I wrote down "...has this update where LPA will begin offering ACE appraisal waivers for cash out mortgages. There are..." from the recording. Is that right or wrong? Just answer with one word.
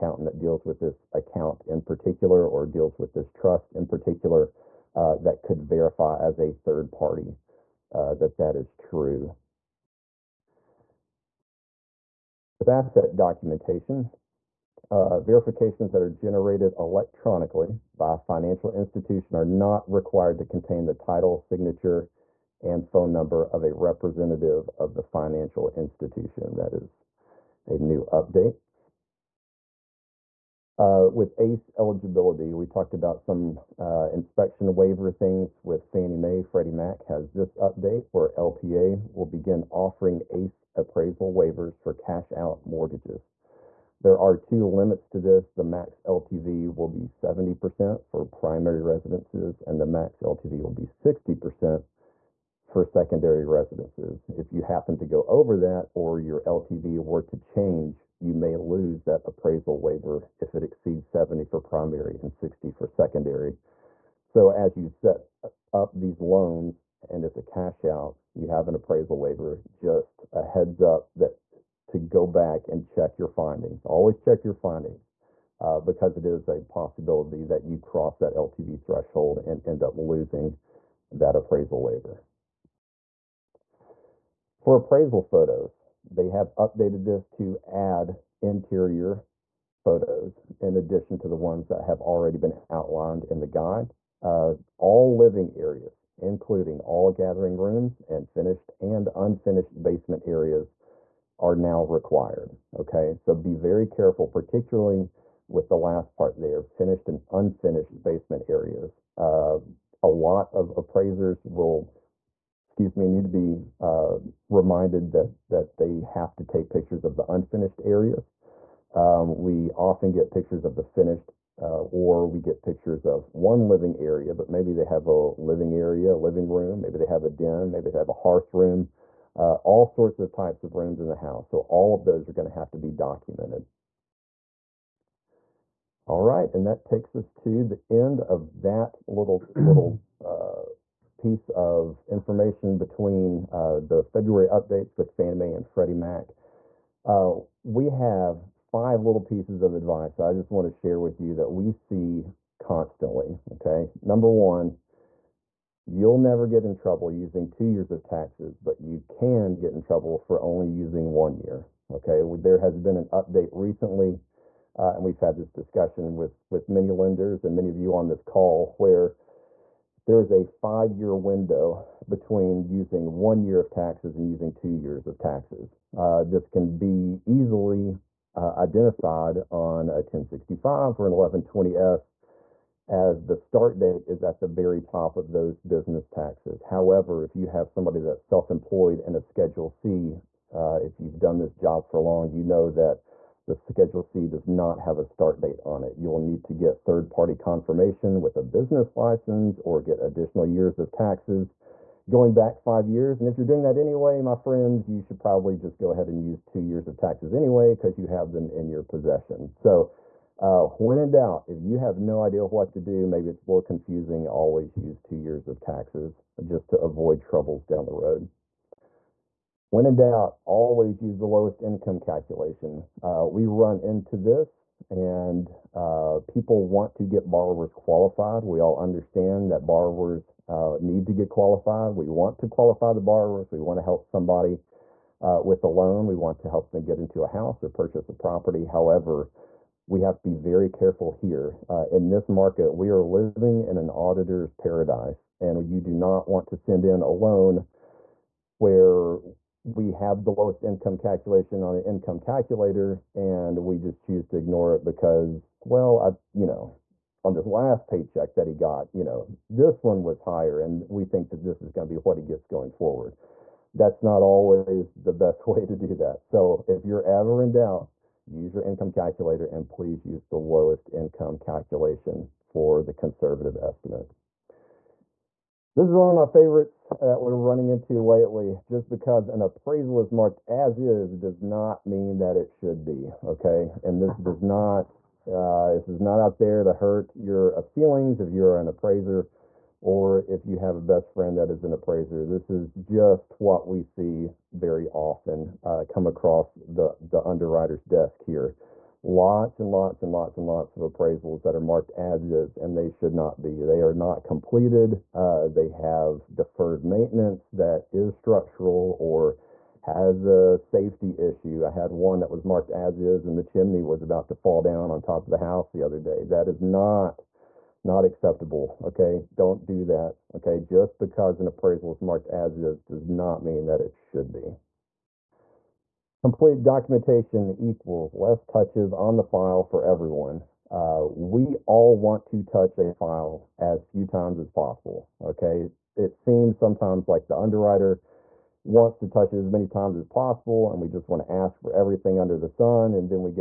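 right.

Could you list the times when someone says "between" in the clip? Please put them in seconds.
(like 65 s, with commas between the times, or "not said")
142 s, 172 s.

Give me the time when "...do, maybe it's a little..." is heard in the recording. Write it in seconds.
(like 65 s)
212 s.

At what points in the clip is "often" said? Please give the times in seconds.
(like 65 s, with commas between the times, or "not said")
119 s, 294 s.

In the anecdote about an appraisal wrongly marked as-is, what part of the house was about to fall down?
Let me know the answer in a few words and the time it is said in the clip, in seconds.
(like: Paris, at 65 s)
Chimney, at 313 s.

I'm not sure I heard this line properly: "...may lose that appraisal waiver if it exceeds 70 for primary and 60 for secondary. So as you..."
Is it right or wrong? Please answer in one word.
right.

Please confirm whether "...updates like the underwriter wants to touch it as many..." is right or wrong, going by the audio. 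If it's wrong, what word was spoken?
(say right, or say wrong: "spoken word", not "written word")
wrong: "sometimes", not "updates".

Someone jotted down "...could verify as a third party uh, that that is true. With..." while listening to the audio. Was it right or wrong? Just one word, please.
right.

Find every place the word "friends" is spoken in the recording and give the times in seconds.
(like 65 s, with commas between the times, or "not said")
204 s, 291 s.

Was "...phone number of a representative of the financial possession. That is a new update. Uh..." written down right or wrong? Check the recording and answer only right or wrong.
wrong.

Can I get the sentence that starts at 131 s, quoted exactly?
So all of those are going to have to be documented.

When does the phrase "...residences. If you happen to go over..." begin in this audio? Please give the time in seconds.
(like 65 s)
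53 s.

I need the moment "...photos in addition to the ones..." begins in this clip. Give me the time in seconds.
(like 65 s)
89 s.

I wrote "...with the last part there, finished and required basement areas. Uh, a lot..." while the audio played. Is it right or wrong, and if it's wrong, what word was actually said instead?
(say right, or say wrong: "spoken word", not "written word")
wrong: "unfinished", not "required".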